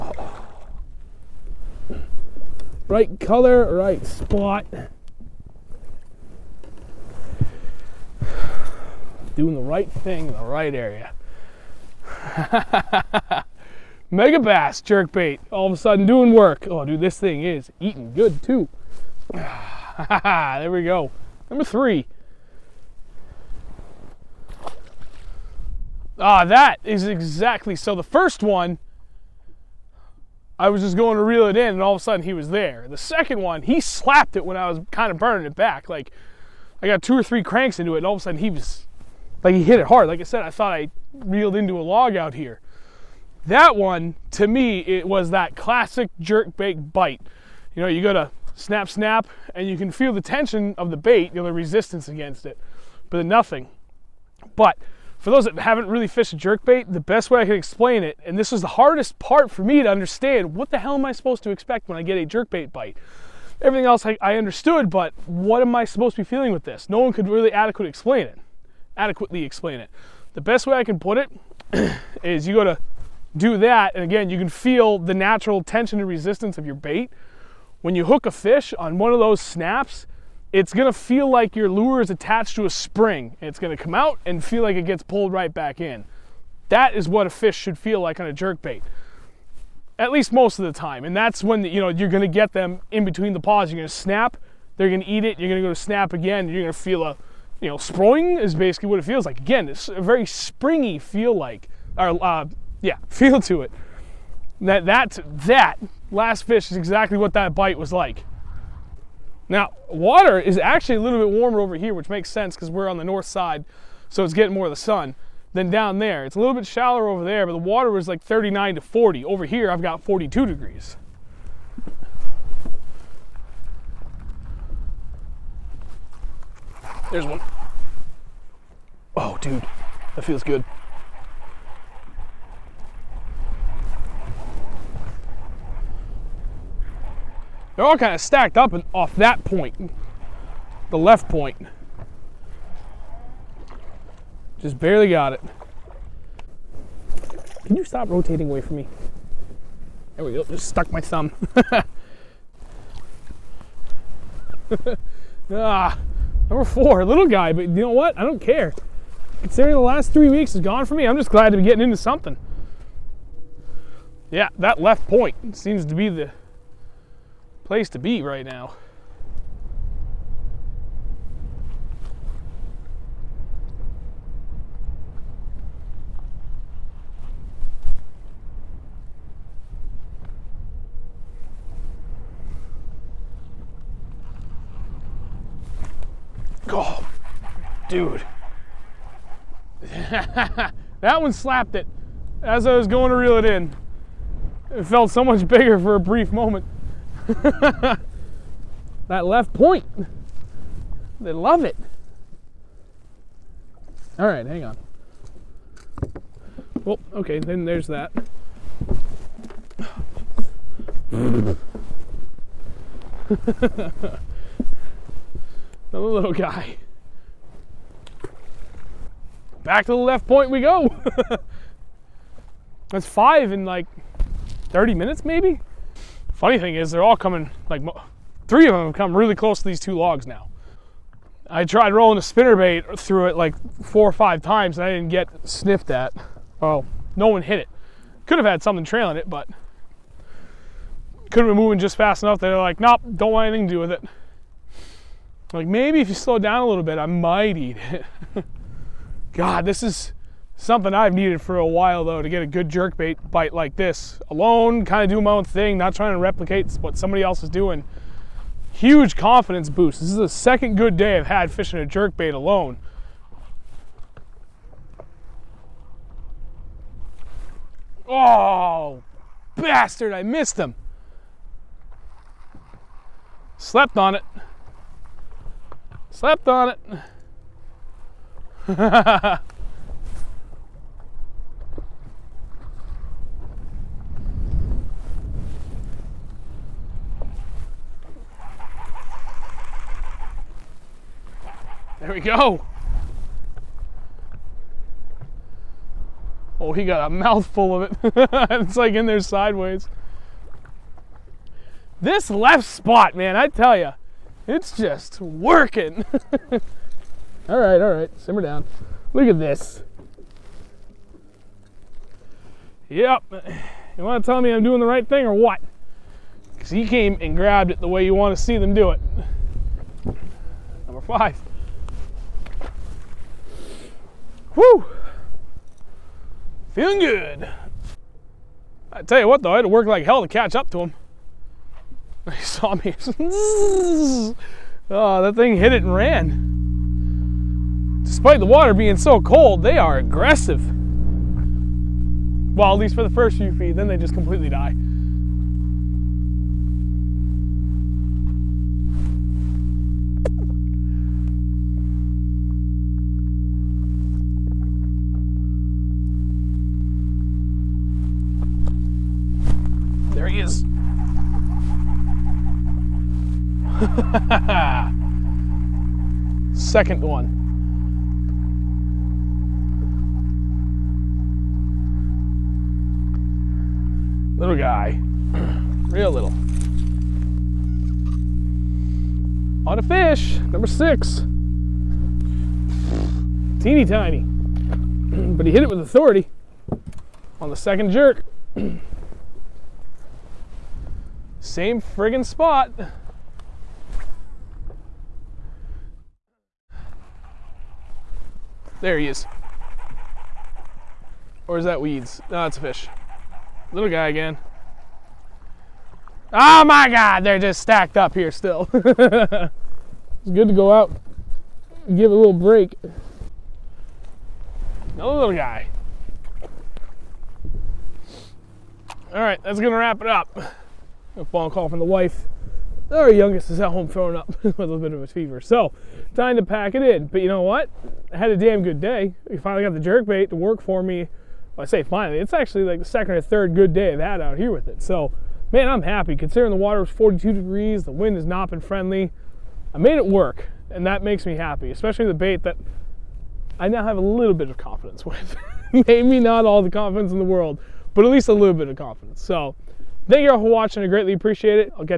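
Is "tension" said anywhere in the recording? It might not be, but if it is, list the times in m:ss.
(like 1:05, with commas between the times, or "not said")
0:50, 1:15.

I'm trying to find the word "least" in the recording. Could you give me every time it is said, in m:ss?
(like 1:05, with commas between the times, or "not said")
1:30, 5:42, 7:28.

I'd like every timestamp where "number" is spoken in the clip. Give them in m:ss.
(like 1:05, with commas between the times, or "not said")
0:21, 2:36, 5:20, 6:20.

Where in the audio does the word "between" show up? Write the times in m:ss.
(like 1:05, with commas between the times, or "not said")
1:33.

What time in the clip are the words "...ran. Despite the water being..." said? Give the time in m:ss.
5:35.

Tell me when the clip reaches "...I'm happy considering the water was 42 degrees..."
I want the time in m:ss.
7:15.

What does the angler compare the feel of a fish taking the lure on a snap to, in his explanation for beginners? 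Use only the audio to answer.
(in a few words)
A spring.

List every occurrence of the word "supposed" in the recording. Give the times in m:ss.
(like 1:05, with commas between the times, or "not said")
1:01, 1:05.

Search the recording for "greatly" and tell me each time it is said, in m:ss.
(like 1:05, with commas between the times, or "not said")
7:30.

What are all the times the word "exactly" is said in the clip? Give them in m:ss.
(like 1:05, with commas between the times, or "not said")
0:27, 1:46.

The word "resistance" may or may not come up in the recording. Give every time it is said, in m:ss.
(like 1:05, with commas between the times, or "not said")
0:51, 1:16.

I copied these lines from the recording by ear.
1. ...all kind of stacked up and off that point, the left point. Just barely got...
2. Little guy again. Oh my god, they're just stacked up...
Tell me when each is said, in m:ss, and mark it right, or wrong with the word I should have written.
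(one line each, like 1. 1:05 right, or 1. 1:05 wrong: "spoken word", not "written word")
1. 2:17 right
2. 6:43 right.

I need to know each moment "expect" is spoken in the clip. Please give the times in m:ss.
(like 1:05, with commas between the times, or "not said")
1:01.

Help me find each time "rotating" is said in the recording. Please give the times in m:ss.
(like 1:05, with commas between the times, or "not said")
2:28.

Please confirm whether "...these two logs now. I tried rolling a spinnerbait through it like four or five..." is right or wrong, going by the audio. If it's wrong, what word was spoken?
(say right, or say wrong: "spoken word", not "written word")
right.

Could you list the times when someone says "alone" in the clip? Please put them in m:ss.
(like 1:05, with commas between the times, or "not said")
4:14, 4:22.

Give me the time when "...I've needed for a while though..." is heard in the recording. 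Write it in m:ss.
4:10.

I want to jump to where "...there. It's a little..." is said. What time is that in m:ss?
1:55.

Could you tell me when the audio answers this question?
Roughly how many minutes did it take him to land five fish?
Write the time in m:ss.
3:44.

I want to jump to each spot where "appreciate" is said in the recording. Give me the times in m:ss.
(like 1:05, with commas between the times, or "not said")
7:31.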